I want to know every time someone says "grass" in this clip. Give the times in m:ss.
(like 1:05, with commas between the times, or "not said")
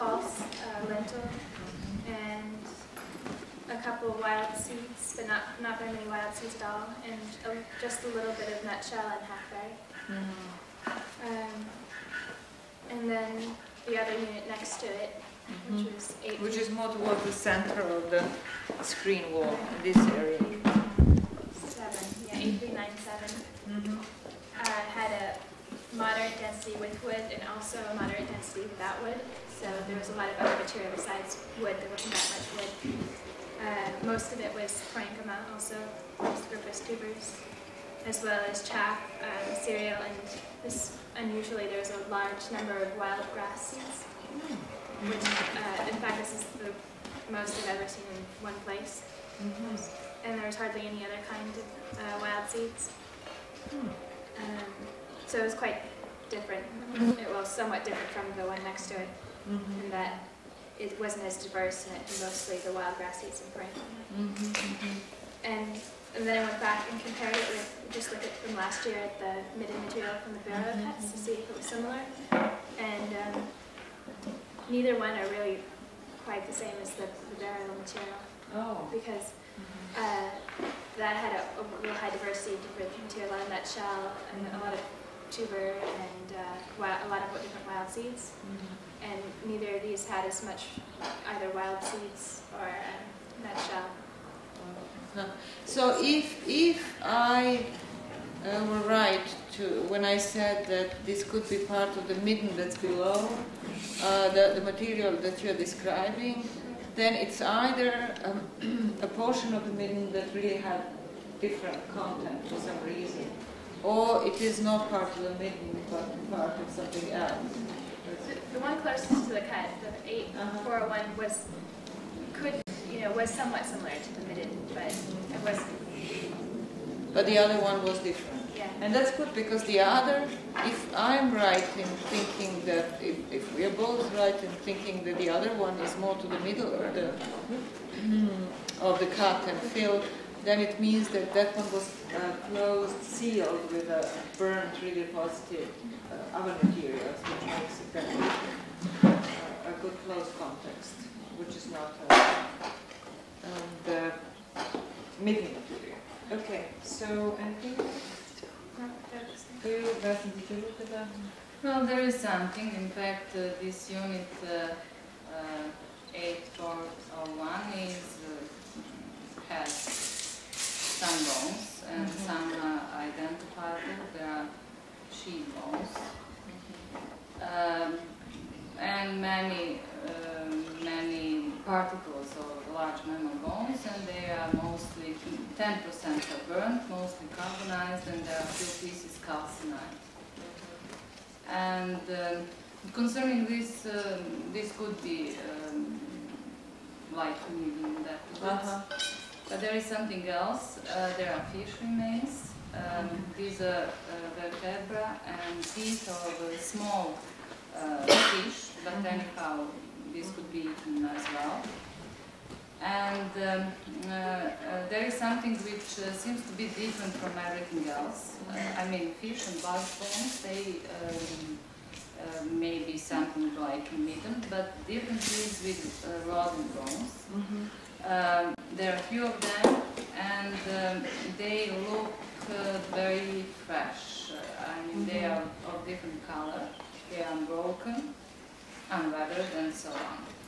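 0:43, 1:02.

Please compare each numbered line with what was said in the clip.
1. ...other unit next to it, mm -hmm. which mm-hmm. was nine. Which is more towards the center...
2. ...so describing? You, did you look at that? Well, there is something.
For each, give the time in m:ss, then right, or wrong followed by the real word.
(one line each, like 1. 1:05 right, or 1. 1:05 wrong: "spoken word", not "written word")
1. 0:14 wrong: "eight", not "nine"
2. 2:36 wrong: "anything", not "describing".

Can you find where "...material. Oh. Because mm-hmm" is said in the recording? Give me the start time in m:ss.
1:17.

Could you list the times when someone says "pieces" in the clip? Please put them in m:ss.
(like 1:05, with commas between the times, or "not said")
3:08.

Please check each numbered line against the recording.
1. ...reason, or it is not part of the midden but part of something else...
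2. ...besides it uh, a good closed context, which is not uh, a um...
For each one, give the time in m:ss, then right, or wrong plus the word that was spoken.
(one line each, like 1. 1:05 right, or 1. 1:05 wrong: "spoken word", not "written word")
1. 1:52 right
2. 2:27 wrong: "makes", not "besides".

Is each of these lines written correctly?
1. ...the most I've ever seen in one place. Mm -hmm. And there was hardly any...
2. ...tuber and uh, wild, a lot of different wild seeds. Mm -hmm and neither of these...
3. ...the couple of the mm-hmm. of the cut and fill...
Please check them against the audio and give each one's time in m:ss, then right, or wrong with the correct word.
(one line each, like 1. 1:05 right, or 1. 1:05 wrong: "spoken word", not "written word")
1. 0:46 right
2. 1:25 right
3. 2:16 wrong: "middle", not "couple".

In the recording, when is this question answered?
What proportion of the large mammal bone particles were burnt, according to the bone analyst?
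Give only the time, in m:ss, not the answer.
3:05.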